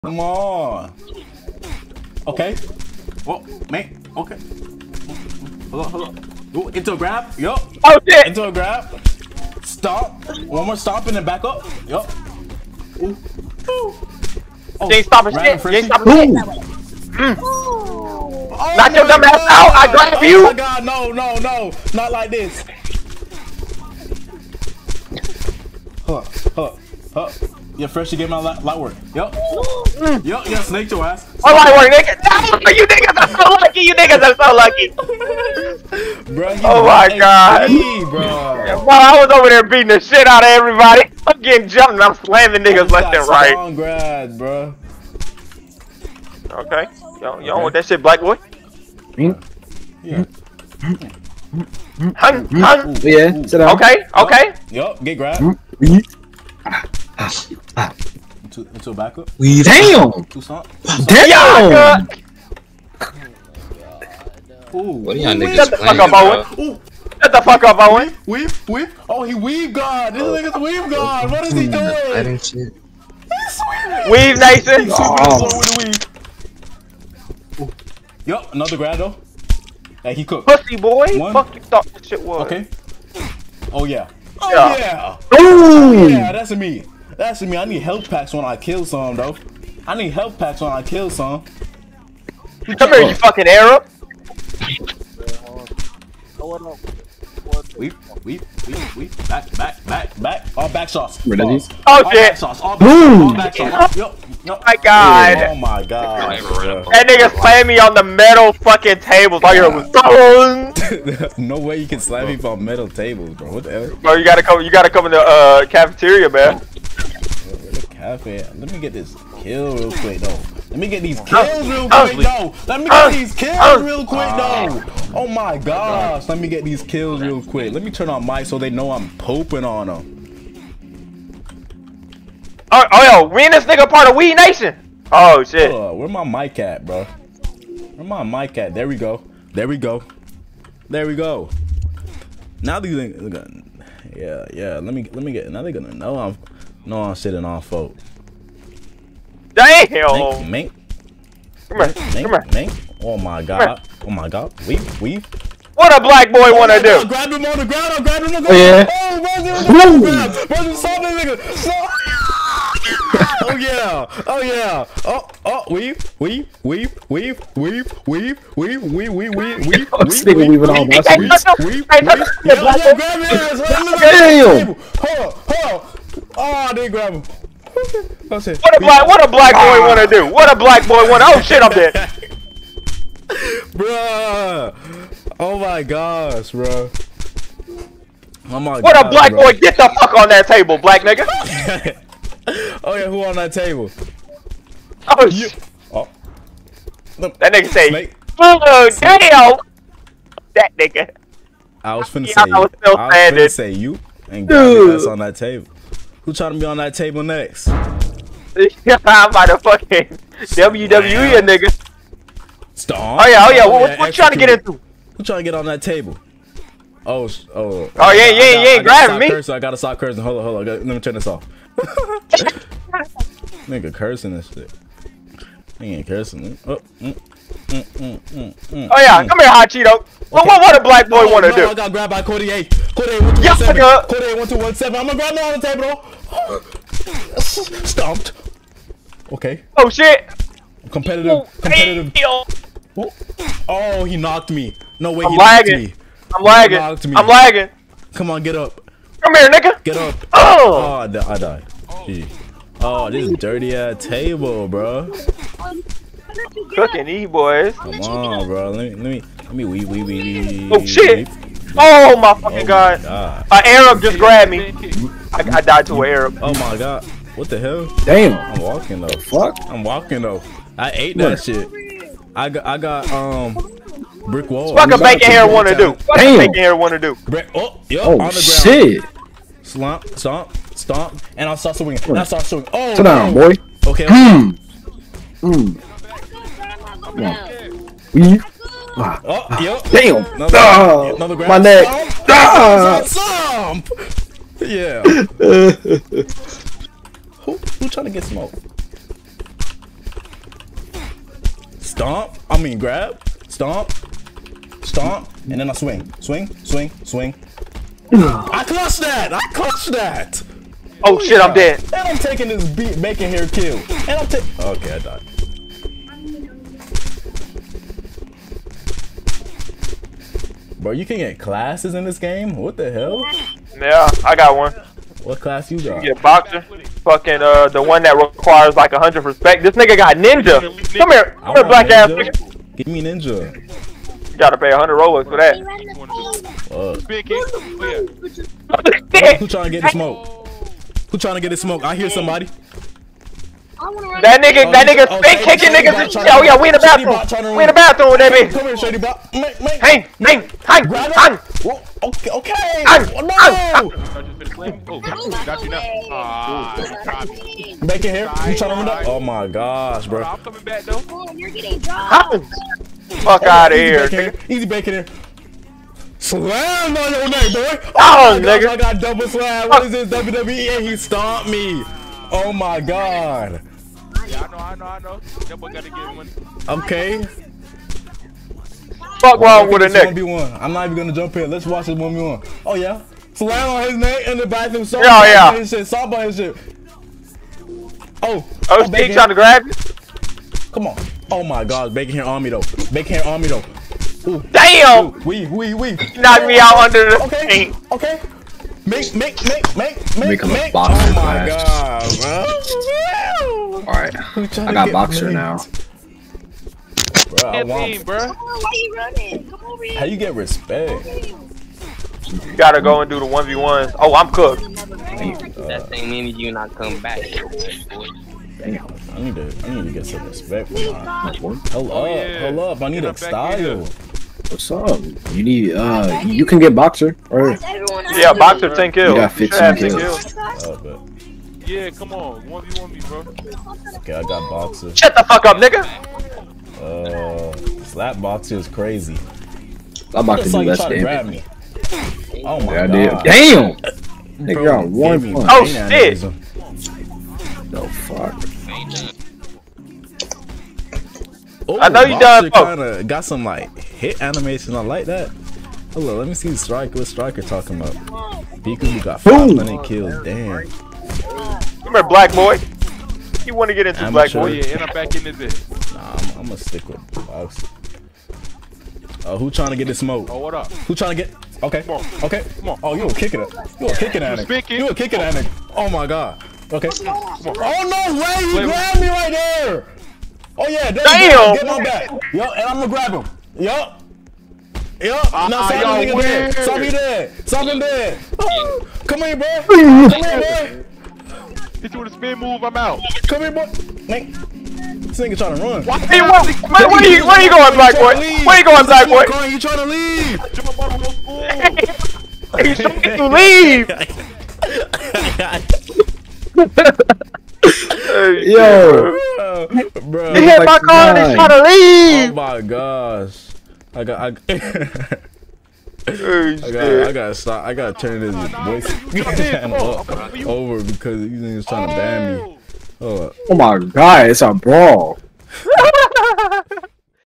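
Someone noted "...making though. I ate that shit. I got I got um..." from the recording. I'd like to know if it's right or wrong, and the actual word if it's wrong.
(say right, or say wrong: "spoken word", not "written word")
wrong: "walking", not "making".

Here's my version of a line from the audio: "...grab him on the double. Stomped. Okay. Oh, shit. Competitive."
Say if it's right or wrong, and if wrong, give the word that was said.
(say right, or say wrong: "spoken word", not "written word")
wrong: "table", not "double".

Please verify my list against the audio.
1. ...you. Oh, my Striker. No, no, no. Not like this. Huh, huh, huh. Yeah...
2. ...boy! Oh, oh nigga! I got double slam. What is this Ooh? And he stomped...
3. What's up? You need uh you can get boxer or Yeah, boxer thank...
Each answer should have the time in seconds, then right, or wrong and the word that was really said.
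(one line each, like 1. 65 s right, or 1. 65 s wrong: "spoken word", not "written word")
1. 20 s wrong: "God", not "Striker"
2. 367 s wrong: "WWE", not "Ooh"
3. 424 s right.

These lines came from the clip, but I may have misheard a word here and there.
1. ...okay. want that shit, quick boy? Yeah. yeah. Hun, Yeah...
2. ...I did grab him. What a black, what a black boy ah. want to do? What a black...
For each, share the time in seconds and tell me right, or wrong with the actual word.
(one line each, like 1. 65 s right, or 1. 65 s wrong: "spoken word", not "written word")
1. 47 s wrong: "black", not "quick"
2. 176 s right.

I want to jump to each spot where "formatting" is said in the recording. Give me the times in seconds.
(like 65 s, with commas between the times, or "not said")
not said.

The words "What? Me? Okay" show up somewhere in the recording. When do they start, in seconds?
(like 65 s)
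3 s.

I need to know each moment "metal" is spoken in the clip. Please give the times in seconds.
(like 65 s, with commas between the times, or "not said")
108 s, 112 s.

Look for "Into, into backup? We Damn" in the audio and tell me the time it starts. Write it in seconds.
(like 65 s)
58 s.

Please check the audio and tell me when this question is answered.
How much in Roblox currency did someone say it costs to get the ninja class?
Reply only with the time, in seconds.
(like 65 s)
334 s.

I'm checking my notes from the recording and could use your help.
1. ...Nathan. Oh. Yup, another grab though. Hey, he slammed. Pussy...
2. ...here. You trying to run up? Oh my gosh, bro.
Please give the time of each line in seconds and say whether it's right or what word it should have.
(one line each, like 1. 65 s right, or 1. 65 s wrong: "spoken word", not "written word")
1. 74 s wrong: "cooked", not "slammed"
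2. 358 s right.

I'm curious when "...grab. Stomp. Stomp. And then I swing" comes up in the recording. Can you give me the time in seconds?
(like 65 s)
302 s.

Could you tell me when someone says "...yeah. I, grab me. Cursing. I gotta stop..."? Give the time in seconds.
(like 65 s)
218 s.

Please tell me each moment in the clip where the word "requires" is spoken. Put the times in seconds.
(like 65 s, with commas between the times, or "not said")
328 s.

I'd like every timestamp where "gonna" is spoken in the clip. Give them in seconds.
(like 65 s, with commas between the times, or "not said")
145 s, 380 s, 466 s, 482 s.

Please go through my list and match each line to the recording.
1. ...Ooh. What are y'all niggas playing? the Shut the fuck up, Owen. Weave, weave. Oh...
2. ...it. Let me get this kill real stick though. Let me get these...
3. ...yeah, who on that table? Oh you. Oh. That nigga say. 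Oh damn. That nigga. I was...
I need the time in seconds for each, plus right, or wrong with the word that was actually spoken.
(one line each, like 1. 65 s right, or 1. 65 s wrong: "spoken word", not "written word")
1. 64 s right
2. 118 s wrong: "quick", not "stick"
3. 192 s right.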